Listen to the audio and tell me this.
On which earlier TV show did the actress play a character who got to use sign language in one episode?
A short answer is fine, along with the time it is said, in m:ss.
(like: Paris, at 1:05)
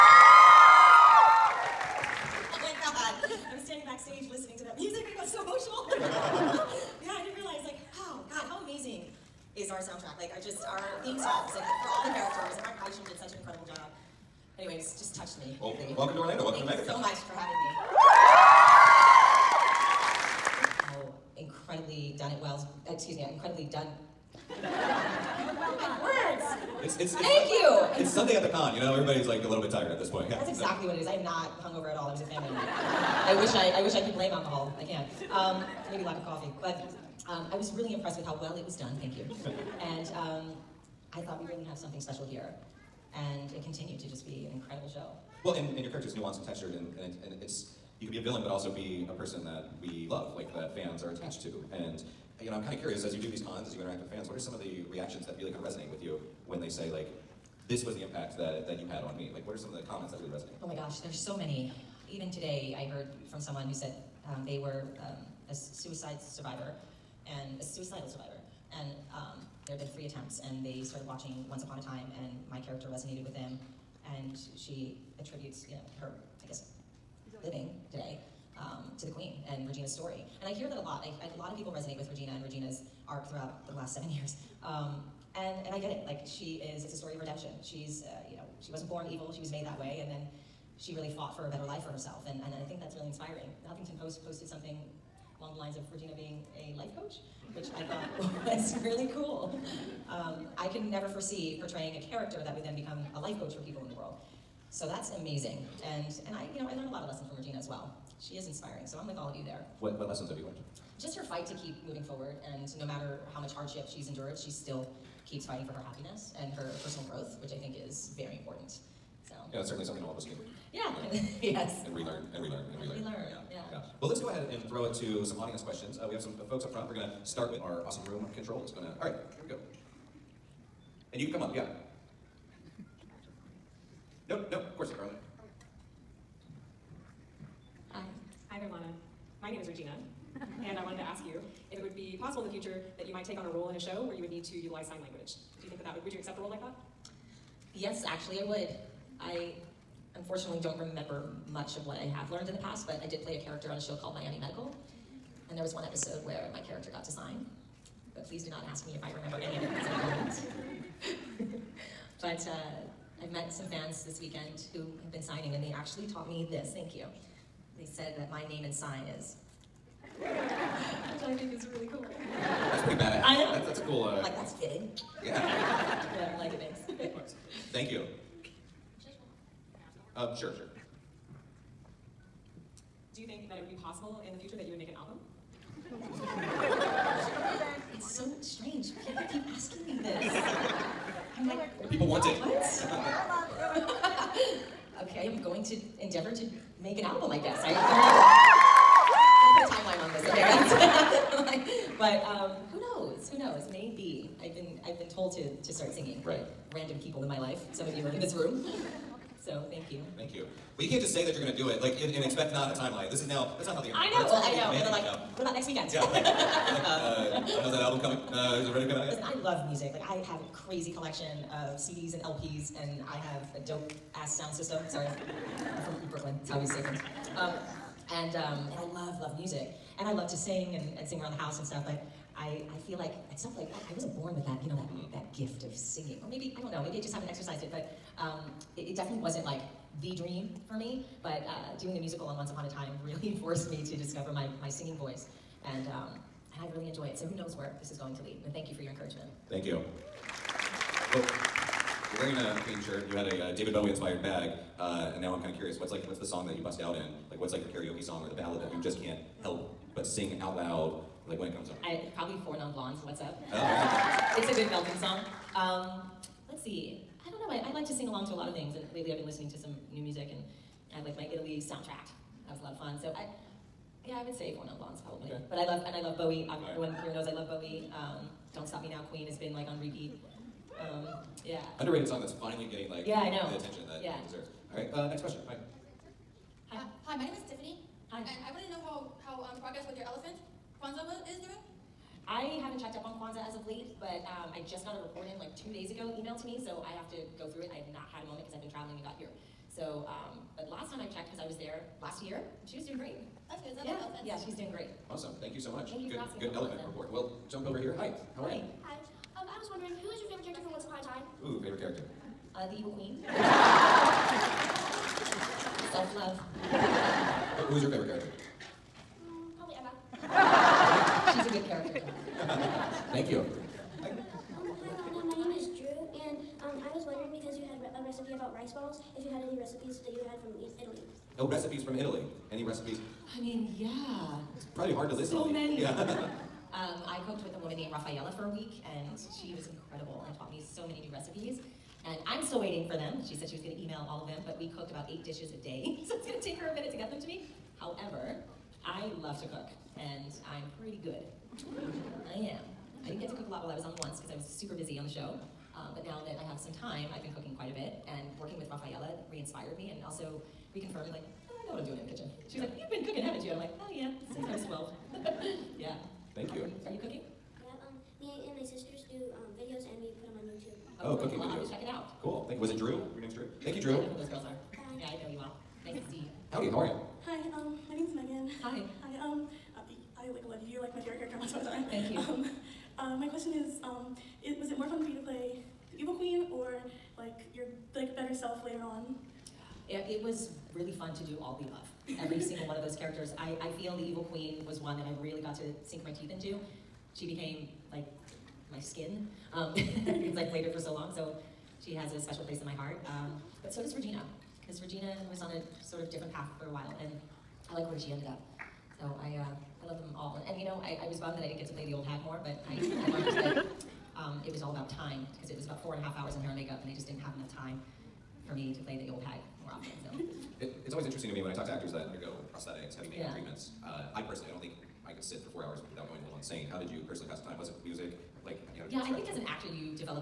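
Miami Medical, at 2:34.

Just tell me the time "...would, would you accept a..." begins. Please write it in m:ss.
2:25.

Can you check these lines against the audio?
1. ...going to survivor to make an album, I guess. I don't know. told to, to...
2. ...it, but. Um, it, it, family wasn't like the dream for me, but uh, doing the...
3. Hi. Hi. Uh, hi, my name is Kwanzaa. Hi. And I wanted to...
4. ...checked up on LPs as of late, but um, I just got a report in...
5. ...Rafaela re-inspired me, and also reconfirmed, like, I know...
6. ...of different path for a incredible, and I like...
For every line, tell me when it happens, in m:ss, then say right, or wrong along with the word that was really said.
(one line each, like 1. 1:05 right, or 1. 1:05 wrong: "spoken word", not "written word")
1. 3:15 wrong: "endeavor", not "survivor"
2. 3:57 wrong: "definitely", not "family"
3. 4:45 wrong: "Tiffany", not "Kwanzaa"
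4. 4:52 wrong: "Kwanzaa", not "LPs"
5. 5:58 right
6. 6:45 wrong: "while", not "incredible".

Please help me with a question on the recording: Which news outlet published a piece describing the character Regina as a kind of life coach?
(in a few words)
The Huffington Post.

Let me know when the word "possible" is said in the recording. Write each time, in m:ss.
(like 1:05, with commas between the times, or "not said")
2:22, 3:03.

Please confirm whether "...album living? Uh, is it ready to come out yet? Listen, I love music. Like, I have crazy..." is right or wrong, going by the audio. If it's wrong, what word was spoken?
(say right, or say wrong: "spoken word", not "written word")
wrong: "coming", not "living".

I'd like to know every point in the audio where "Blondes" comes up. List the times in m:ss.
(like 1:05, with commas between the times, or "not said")
4:22, 4:34.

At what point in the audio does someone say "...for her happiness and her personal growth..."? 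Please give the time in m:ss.
1:55.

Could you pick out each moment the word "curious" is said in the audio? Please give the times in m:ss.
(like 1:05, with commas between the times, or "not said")
0:52, 4:15.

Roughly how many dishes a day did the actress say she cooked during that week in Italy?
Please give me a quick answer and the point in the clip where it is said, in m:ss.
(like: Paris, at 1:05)
8, at 5:45.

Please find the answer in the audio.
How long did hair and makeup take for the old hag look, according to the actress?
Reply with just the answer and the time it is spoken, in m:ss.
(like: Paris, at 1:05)
4 and a half hours, at 6:55.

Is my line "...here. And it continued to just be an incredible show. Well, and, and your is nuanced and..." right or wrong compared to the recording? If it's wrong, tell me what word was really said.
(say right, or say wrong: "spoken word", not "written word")
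right.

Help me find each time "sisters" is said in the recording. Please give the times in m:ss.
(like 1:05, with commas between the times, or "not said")
6:08.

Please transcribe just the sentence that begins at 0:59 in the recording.
Like, what are some of the comments that really resonate?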